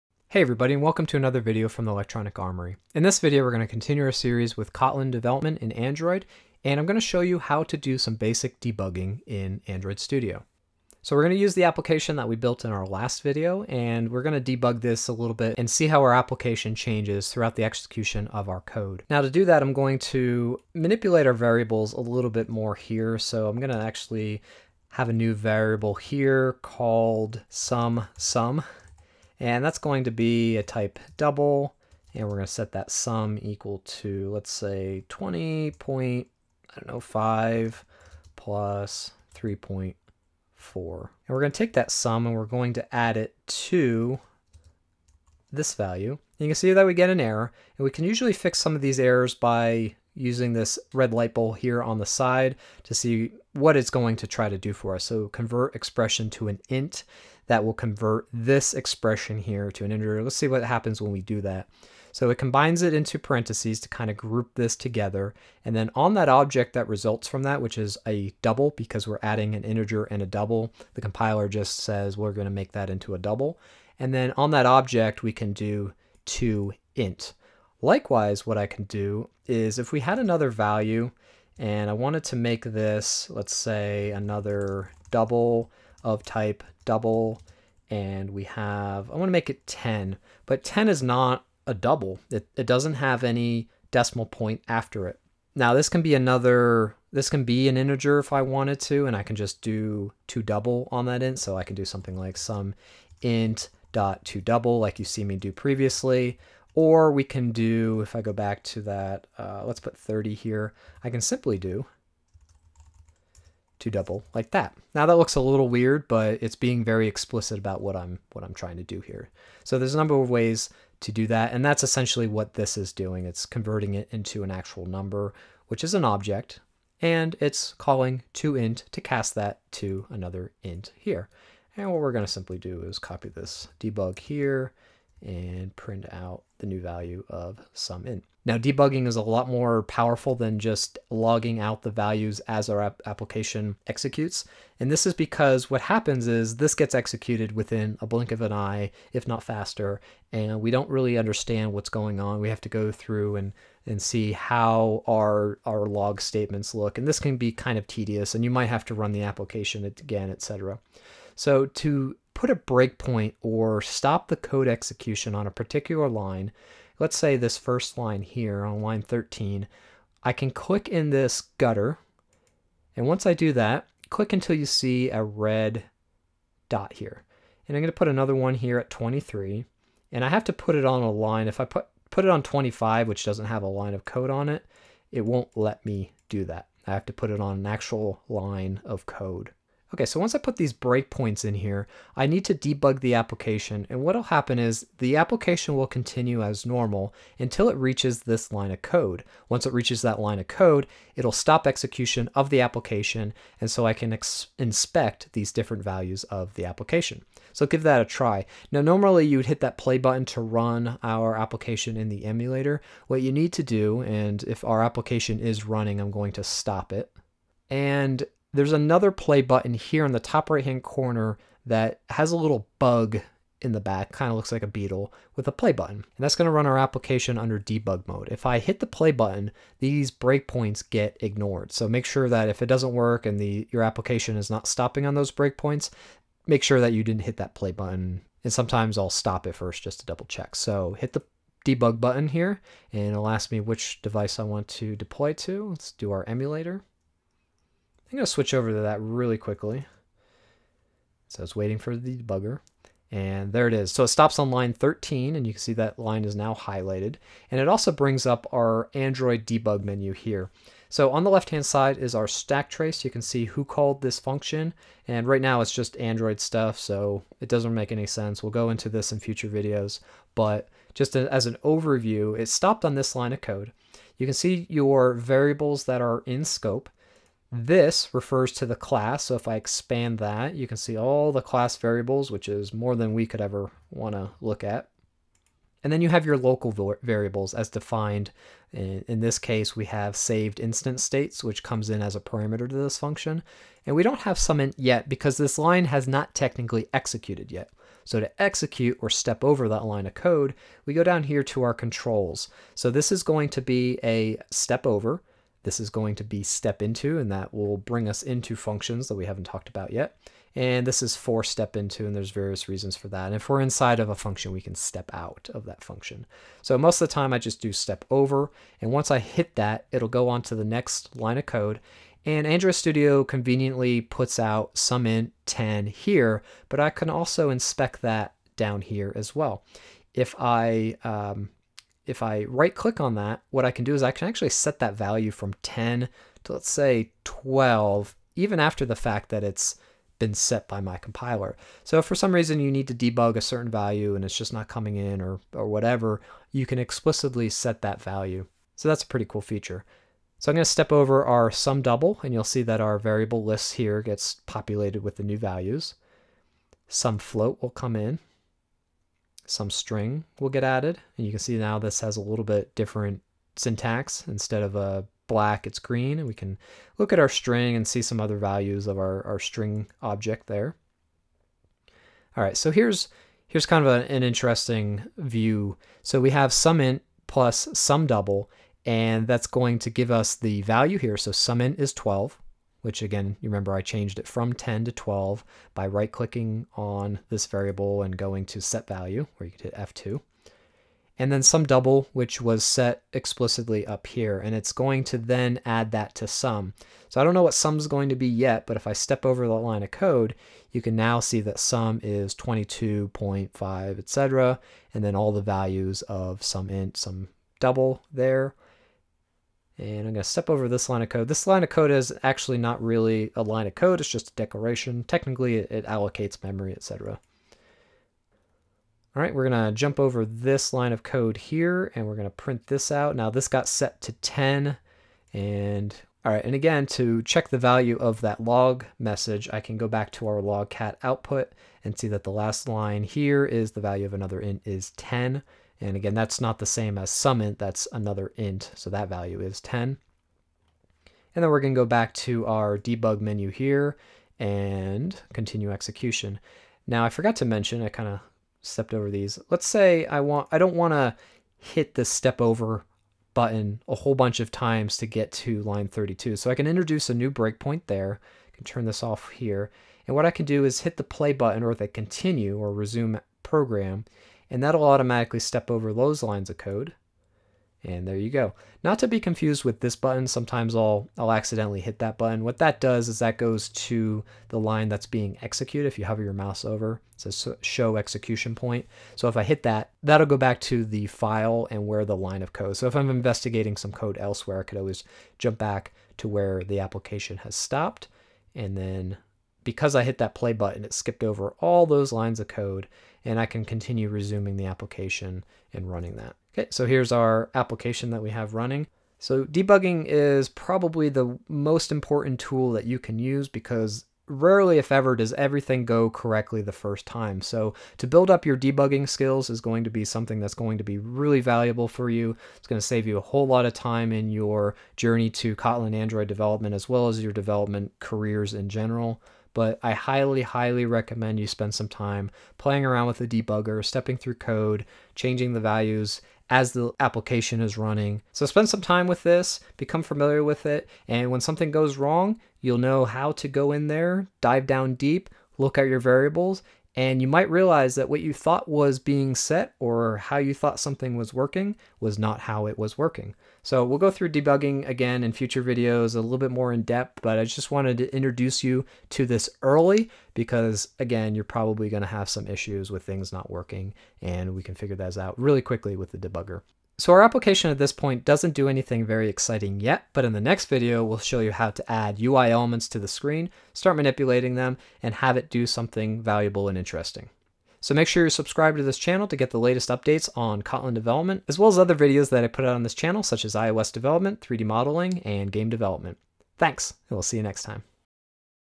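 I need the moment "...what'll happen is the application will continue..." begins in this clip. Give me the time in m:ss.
3:14.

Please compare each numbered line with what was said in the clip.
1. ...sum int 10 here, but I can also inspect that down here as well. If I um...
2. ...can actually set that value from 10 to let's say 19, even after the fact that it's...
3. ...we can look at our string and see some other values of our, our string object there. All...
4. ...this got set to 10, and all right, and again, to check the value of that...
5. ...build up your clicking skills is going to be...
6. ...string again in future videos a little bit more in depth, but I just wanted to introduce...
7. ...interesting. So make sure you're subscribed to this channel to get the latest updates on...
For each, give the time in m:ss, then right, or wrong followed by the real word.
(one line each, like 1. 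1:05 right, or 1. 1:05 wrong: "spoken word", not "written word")
1. 5:24 right
2. 5:34 wrong: "12", not "19"
3. 6:06 right
4. 7:03 right
5. 8:28 wrong: "debugging", not "clicking"
6. 9:04 wrong: "debugging", not "string"
7. 9:26 right.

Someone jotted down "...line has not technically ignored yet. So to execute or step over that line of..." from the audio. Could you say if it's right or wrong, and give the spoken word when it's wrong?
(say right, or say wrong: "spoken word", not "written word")
wrong: "executed", not "ignored".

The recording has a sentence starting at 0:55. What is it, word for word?
So convert expression to an int that will convert this expression here to an integer.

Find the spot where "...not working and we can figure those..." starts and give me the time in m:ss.
9:13.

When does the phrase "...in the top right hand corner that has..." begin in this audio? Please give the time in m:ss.
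3:40.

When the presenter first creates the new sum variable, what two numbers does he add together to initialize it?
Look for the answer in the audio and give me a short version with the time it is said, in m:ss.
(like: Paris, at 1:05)
5 plus 3.4, at 0:36.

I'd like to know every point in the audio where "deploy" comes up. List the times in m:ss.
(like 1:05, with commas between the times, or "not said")
4:04.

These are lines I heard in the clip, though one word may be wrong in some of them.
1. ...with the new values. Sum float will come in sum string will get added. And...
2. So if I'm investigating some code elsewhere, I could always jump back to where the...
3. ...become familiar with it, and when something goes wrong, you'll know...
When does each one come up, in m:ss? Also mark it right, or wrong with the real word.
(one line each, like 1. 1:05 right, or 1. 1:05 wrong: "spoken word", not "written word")
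1. 5:55 right
2. 8:02 right
3. 8:49 right.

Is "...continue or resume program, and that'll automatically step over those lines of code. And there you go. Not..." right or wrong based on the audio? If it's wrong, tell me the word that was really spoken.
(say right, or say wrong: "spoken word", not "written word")
right.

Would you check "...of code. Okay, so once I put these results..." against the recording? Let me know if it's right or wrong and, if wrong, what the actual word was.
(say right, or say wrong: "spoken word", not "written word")
wrong: "breakpoints", not "results".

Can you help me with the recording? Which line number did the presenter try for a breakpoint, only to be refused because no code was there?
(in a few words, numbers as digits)
25.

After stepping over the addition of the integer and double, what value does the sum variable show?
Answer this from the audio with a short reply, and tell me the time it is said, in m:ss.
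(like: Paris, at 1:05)
22.5, at 6:42.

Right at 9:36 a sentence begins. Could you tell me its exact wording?
Thanks, and we'll see you next time.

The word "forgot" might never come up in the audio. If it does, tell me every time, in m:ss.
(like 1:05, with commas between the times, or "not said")
7:27.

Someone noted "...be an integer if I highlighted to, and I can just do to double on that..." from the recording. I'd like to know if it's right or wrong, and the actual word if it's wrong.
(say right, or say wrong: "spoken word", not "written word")
wrong: "wanted", not "highlighted".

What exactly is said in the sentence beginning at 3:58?
And sometimes I'll stop it first just to double check.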